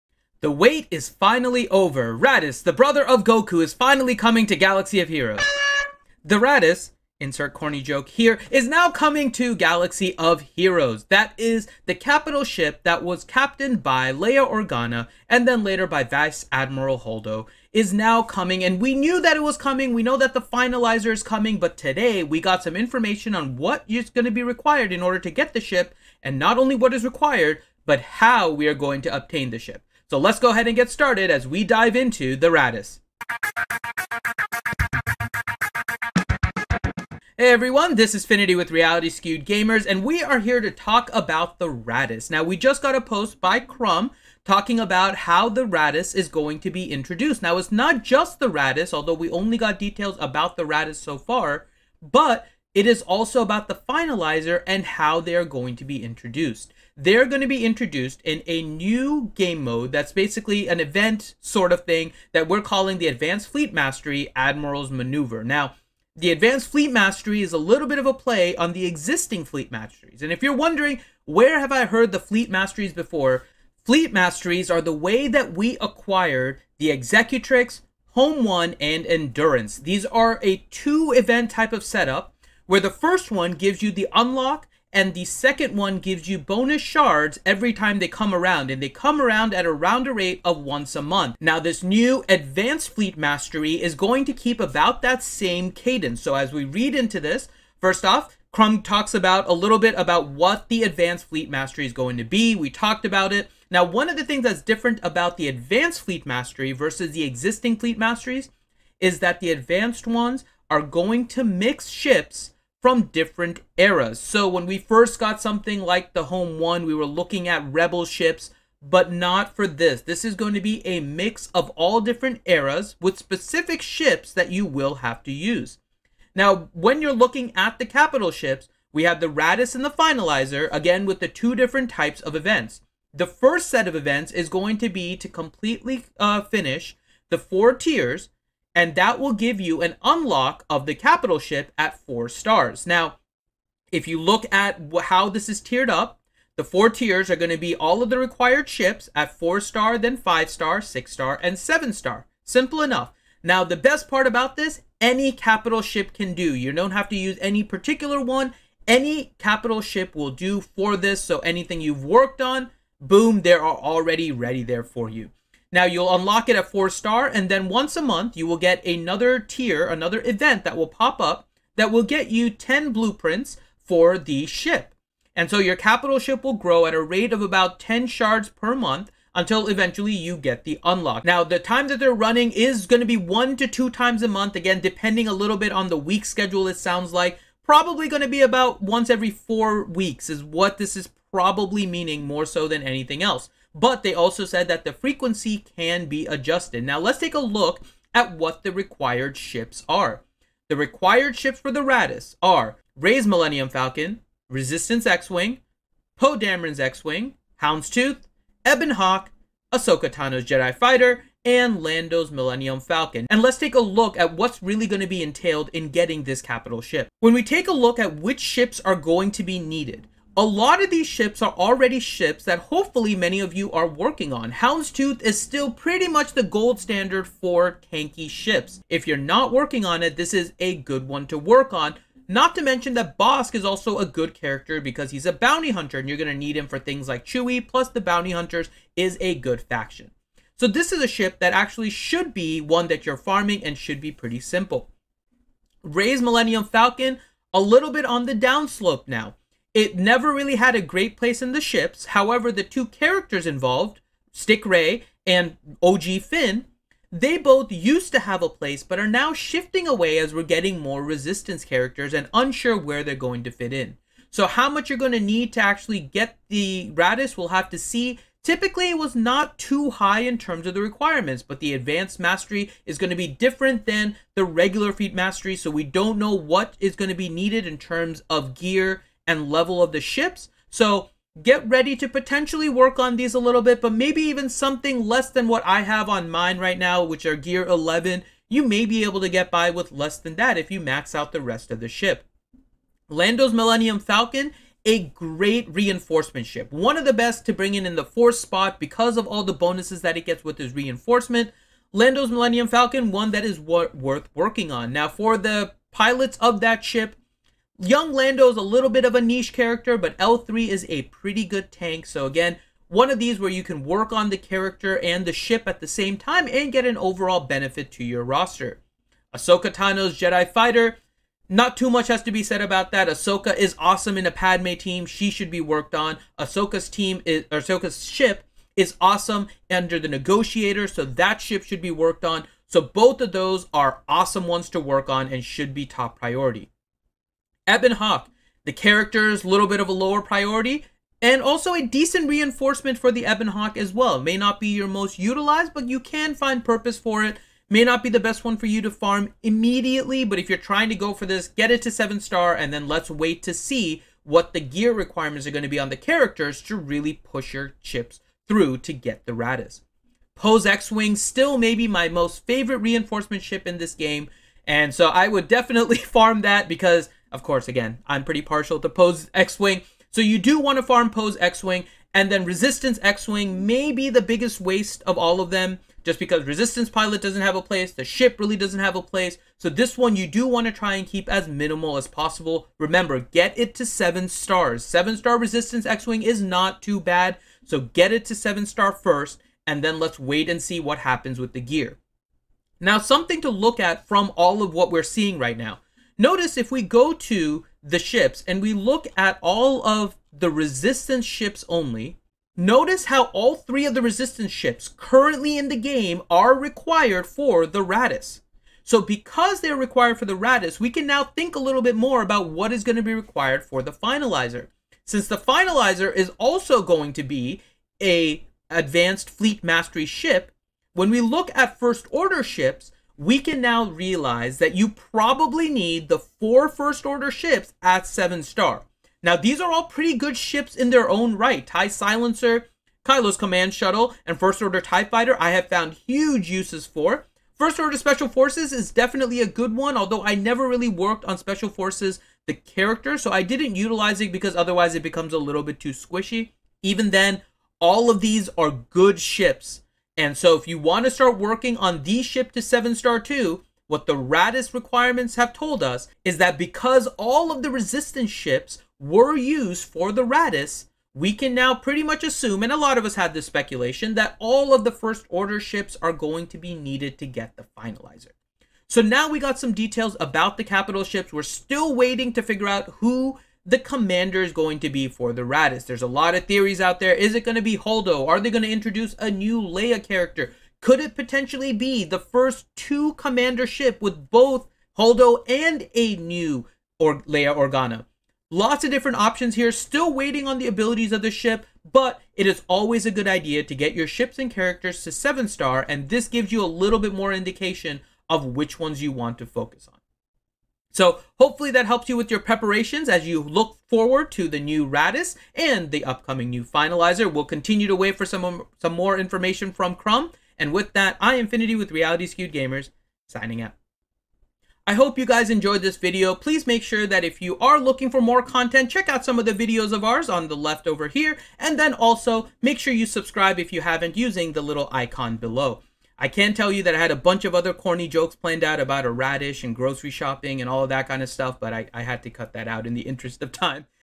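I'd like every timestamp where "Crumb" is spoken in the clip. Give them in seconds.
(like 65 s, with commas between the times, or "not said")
43 s, 98 s, 509 s.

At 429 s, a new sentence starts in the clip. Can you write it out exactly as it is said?
Now, these are all pretty good ships in their own right.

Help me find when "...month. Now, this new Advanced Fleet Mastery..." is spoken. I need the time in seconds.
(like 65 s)
91 s.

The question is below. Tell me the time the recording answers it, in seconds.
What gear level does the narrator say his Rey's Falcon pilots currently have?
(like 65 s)
287 s.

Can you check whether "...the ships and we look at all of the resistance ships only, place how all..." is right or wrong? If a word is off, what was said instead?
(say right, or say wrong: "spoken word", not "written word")
wrong: "notice", not "place".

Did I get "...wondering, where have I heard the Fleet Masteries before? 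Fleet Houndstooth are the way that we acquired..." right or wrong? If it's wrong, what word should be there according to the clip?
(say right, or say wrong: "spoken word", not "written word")
wrong: "Masteries", not "Houndstooth".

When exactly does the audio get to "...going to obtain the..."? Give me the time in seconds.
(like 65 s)
28 s.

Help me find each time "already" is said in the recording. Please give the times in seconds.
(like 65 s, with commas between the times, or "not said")
163 s, 221 s.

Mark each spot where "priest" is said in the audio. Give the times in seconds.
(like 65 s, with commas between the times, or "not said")
not said.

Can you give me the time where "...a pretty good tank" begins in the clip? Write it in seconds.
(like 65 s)
310 s.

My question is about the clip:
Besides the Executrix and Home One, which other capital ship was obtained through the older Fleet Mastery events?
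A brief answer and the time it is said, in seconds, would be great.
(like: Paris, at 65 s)
Endurance, at 79 s.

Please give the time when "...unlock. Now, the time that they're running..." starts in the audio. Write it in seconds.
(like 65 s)
180 s.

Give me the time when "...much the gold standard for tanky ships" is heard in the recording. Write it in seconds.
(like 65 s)
226 s.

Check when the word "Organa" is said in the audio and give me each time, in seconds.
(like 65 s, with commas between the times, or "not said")
14 s, 487 s.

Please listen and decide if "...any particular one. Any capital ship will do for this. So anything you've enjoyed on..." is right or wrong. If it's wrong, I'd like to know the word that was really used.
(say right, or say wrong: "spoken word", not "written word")
wrong: "worked", not "enjoyed".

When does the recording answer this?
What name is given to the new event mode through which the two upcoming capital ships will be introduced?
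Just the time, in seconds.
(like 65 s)
64 s.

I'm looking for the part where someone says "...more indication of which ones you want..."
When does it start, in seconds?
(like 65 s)
497 s.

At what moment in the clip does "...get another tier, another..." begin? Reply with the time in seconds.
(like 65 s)
168 s.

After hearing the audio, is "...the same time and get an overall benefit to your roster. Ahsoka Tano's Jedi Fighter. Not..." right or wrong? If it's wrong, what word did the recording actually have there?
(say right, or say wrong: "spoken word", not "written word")
right.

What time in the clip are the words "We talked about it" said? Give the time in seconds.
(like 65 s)
102 s.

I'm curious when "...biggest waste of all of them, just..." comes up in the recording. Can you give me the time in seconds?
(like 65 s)
374 s.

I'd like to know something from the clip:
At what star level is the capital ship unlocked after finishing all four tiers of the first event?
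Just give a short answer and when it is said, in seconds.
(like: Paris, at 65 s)
4 stars, at 141 s.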